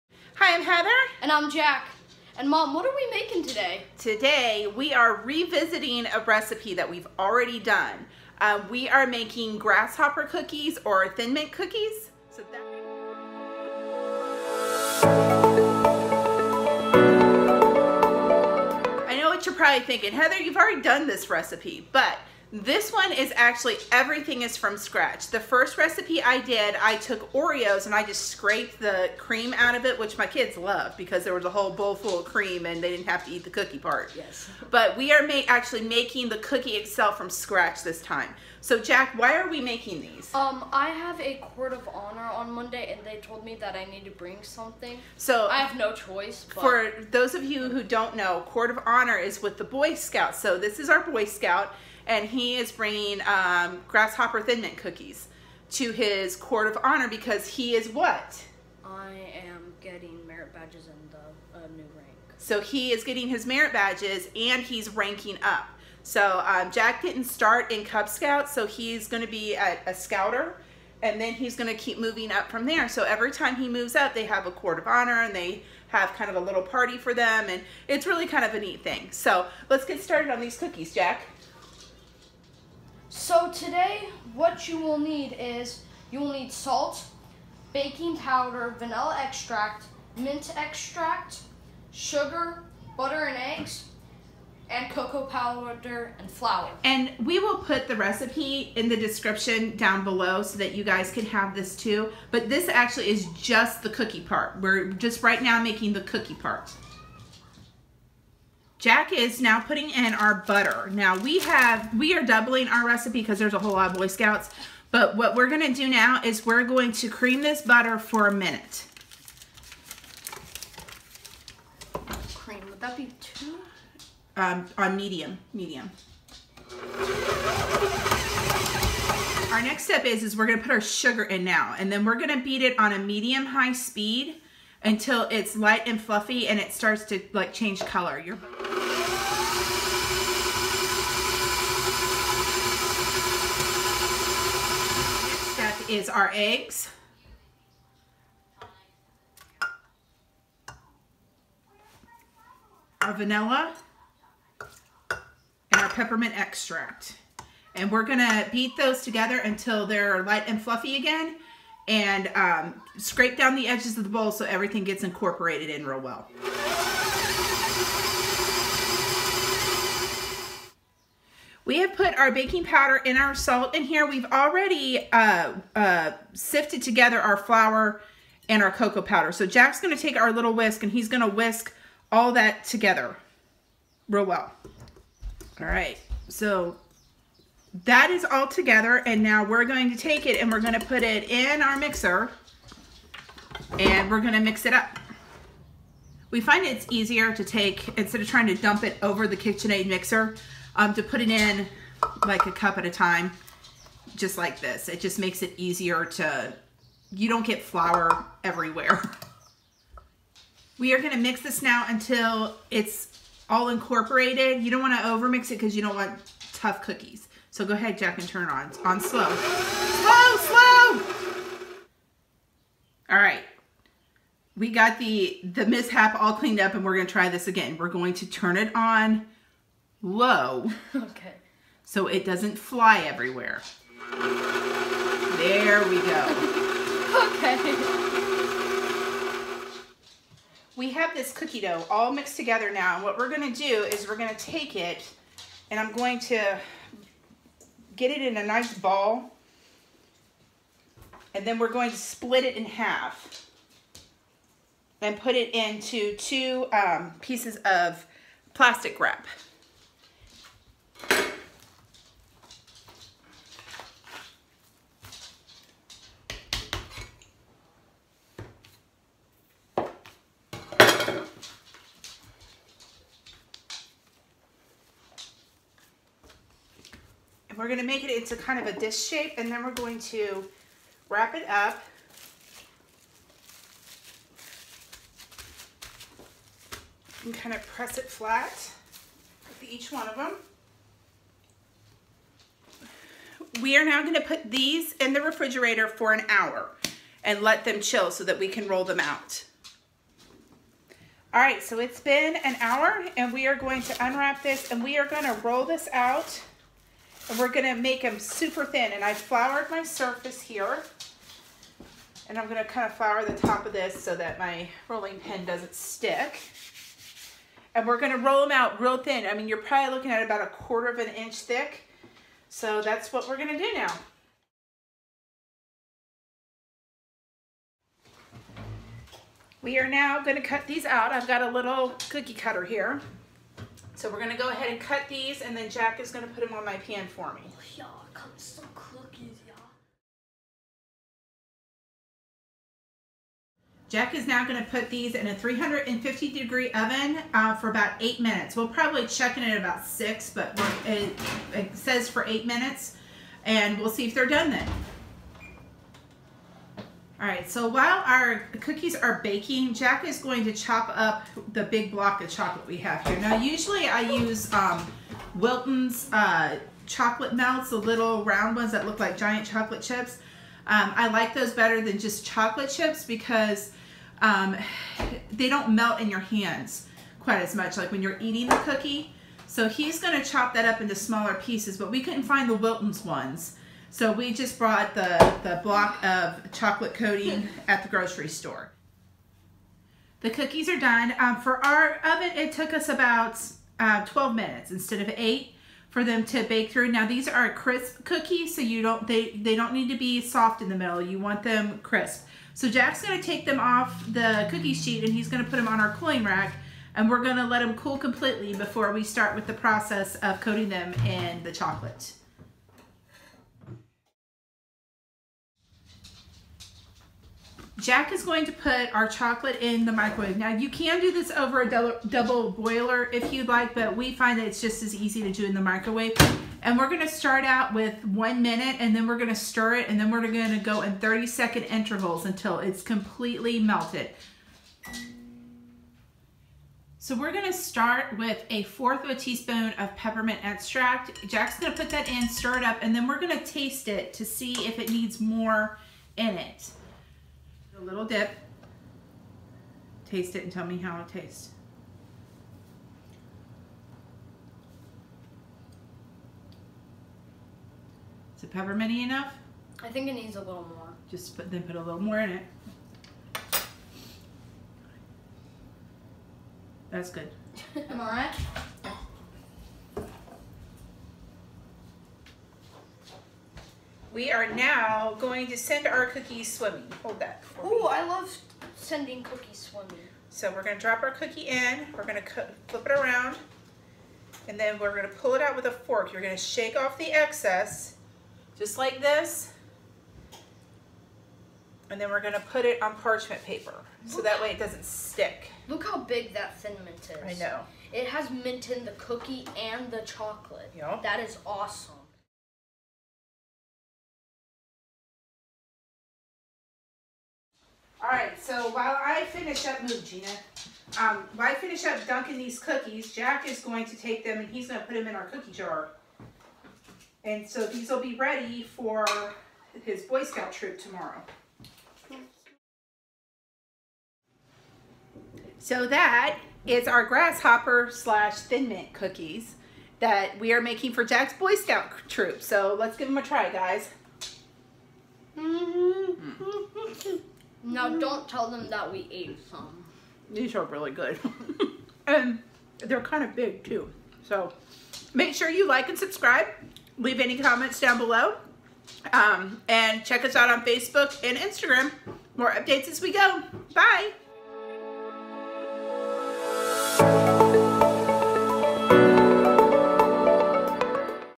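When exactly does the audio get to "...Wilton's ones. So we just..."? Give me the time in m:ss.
6:22.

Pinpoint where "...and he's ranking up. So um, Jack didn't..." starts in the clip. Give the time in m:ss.
1:04.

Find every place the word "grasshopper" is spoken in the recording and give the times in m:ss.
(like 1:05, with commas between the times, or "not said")
0:09, 0:53, 8:47.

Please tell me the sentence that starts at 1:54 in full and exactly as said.
But what we're gonna do now is we're going to cream this butter for a minute.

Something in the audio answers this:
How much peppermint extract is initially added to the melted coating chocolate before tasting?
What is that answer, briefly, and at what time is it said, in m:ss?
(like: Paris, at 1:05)
A fourth of a teaspoon, at 7:18.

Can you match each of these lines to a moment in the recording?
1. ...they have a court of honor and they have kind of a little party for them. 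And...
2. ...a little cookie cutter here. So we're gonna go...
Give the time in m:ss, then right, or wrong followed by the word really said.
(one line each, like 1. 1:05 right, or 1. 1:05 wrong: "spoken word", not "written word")
1. 1:14 right
2. 5:31 right.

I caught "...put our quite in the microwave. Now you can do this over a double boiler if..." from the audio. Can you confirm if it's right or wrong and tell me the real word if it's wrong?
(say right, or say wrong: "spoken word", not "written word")
wrong: "chocolate", not "quite".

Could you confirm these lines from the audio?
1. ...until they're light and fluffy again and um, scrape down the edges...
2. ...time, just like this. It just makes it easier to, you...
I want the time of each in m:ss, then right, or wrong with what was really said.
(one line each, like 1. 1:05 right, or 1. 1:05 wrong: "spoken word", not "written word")
1. 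2:39 right
2. 3:22 right.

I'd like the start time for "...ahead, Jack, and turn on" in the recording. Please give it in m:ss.
3:37.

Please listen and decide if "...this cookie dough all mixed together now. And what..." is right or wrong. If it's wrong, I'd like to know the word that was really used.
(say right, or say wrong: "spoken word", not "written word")
right.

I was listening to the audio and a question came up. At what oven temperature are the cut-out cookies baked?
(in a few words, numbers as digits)
350 degrees.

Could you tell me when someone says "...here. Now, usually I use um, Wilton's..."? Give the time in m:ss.
6:03.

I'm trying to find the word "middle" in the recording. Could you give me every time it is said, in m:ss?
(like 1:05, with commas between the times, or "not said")
6:40.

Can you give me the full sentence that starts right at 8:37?
And so these will be ready for his Boy Scout troop tomorrow.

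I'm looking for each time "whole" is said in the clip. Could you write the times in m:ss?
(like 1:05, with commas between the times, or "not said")
0:31, 1:53.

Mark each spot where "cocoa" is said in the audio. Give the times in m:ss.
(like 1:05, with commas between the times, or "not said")
1:34, 2:58.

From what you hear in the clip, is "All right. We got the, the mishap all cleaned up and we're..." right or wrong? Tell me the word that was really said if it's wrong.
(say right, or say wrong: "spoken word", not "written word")
right.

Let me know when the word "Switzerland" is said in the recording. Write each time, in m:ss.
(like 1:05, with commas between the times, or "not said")
not said.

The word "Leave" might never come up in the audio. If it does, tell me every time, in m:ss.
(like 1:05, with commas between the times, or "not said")
9:06.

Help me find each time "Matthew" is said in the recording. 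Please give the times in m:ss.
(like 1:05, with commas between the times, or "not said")
not said.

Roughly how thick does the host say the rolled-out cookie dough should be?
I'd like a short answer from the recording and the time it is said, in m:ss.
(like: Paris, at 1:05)
A quarter of an inch, at 5:20.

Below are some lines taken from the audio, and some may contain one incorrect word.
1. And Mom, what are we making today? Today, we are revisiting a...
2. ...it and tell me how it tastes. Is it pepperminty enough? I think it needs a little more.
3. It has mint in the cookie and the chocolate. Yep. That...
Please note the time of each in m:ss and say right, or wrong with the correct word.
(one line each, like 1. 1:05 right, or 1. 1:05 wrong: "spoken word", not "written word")
1. 0:02 right
2. 7:30 right
3. 8:17 right.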